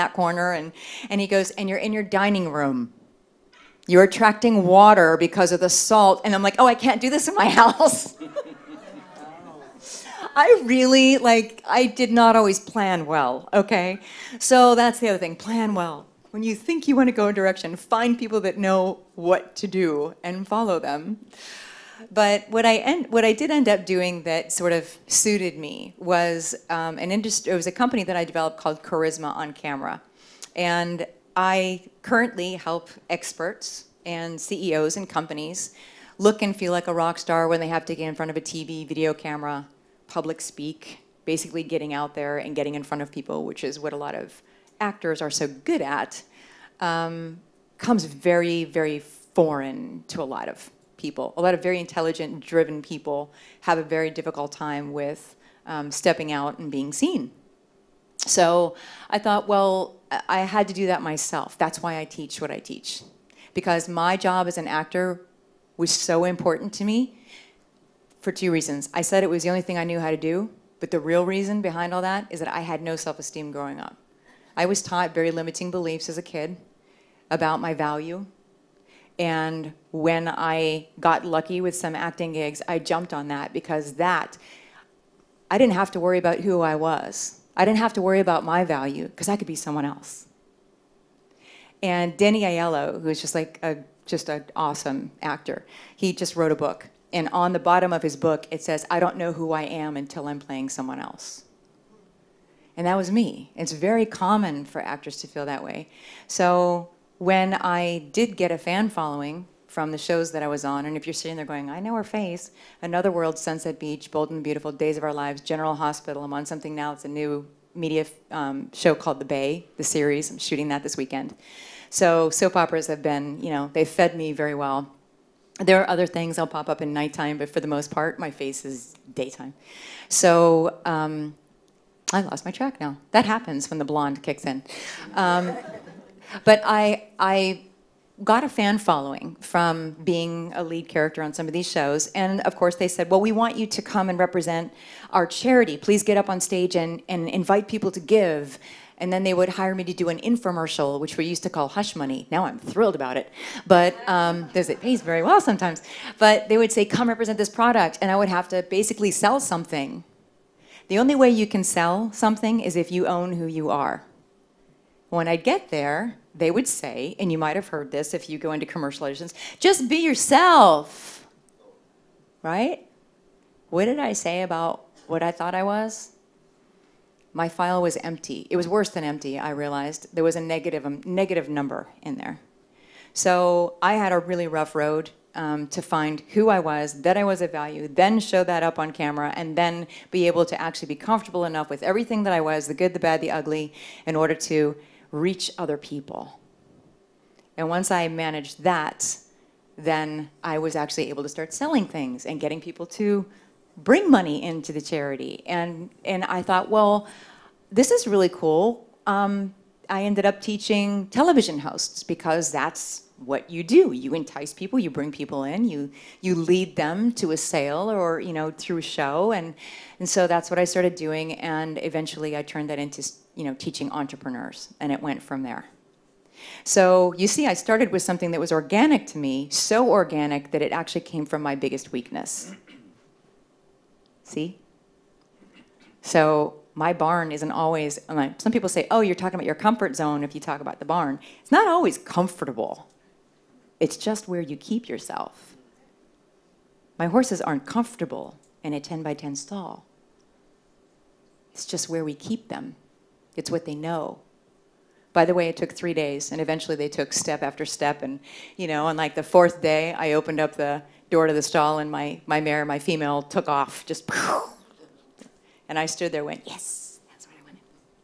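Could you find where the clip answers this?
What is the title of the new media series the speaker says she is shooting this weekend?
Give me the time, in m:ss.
1:59.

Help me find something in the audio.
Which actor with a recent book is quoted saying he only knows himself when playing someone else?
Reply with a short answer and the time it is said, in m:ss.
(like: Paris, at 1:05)
Danny Aiello, at 1:32.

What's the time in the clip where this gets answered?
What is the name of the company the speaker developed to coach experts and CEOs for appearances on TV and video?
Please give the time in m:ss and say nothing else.
0:28.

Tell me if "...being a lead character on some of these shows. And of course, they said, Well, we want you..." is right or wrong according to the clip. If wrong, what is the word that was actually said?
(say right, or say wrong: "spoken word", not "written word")
right.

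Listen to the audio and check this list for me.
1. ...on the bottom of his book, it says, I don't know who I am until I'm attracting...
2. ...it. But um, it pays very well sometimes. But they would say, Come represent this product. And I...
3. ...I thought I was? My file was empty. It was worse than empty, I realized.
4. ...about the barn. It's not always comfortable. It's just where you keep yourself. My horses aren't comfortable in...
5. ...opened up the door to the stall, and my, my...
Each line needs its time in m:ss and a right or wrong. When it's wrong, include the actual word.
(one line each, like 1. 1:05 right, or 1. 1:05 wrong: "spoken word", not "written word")
1. 1:37 wrong: "playing", not "attracting"
2. 2:33 right
3. 2:55 right
4. 4:00 right
5. 4:20 right.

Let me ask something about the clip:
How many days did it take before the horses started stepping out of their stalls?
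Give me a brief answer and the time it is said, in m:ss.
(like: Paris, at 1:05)
3, at 4:15.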